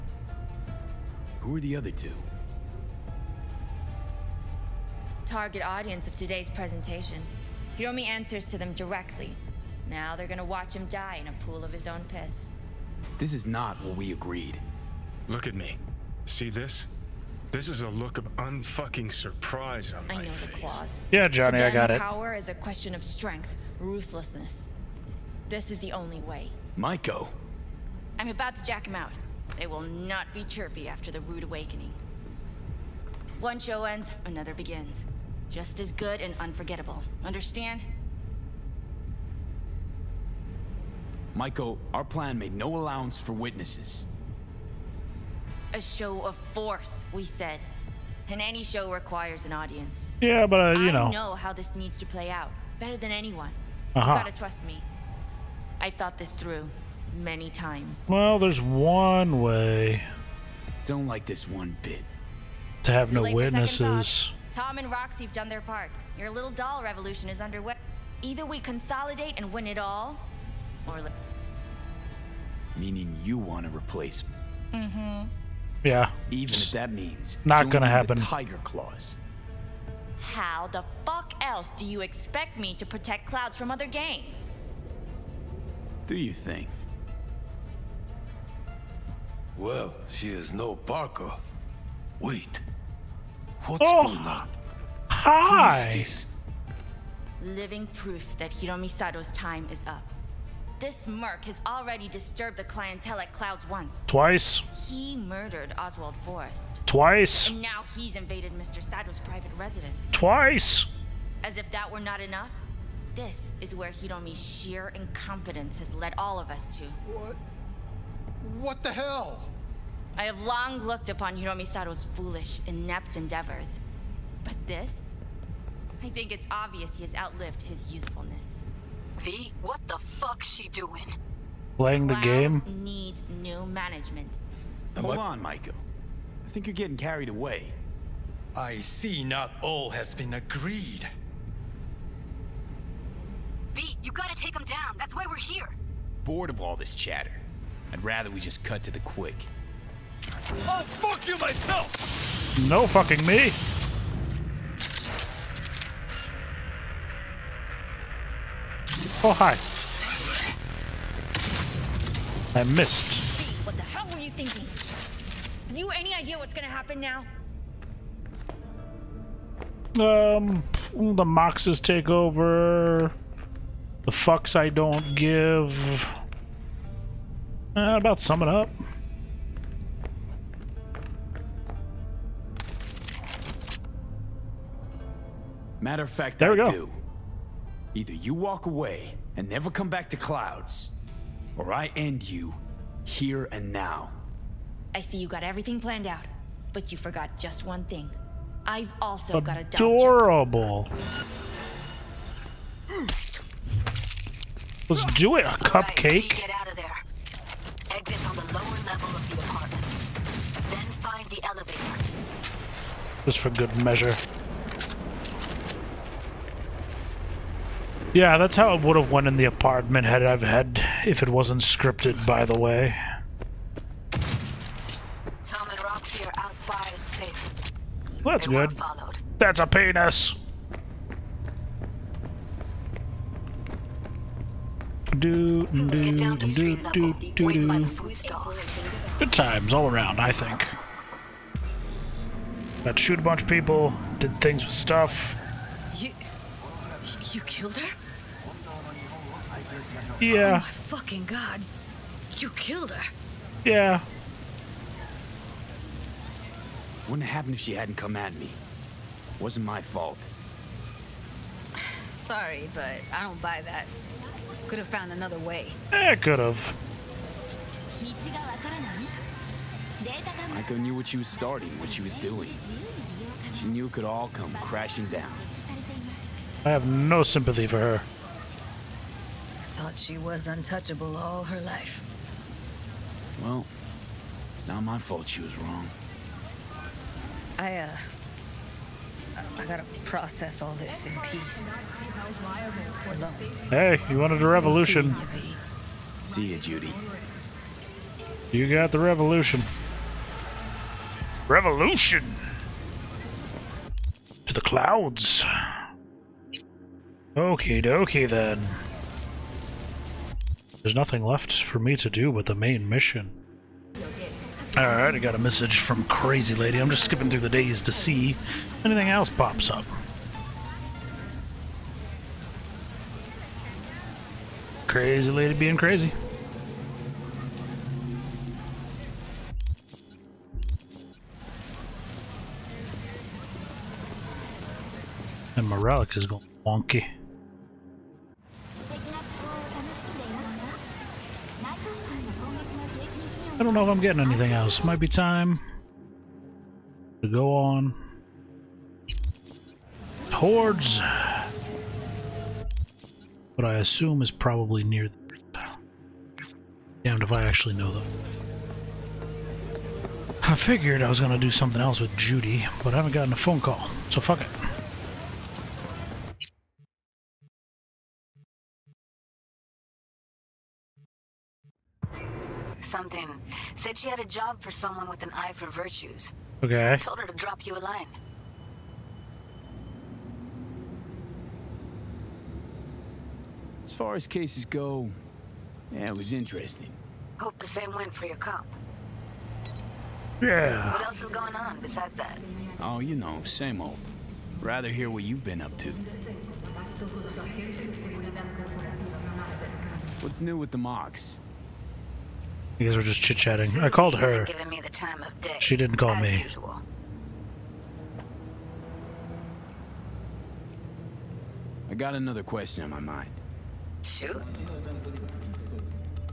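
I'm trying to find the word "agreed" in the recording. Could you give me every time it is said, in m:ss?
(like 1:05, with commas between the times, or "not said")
0:14, 2:20.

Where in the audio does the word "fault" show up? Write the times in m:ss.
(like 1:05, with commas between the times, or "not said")
4:19, 4:44.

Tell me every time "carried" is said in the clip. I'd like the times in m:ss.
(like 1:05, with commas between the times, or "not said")
2:16.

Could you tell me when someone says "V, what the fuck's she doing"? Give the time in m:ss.
2:09.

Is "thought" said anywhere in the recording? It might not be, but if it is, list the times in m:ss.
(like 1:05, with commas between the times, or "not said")
0:55, 4:39.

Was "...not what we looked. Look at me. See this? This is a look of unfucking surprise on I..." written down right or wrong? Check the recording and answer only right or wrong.
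wrong.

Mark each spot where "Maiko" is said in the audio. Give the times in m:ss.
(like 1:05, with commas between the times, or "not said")
0:26, 0:41, 2:15, 4:30.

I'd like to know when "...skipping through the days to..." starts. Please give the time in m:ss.
5:17.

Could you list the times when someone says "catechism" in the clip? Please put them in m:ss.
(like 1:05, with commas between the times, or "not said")
not said.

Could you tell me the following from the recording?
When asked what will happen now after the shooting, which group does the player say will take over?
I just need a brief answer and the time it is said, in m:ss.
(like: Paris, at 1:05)
the Moxes, at 2:50.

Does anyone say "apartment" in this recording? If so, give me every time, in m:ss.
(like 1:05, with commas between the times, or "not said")
3:29, 3:39.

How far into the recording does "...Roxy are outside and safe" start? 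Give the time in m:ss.
3:45.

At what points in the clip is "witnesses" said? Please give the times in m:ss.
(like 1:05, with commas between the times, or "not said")
0:43, 1:03.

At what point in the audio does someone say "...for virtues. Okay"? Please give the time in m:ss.
6:15.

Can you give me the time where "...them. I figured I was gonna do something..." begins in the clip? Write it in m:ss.
5:57.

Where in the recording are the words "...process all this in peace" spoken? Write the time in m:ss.
4:50.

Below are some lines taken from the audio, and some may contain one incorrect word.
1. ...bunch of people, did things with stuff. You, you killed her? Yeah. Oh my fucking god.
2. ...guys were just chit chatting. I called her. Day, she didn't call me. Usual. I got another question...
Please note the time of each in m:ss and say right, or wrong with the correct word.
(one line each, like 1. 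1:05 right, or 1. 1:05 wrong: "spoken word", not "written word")
1. 4:03 right
2. 6:42 right.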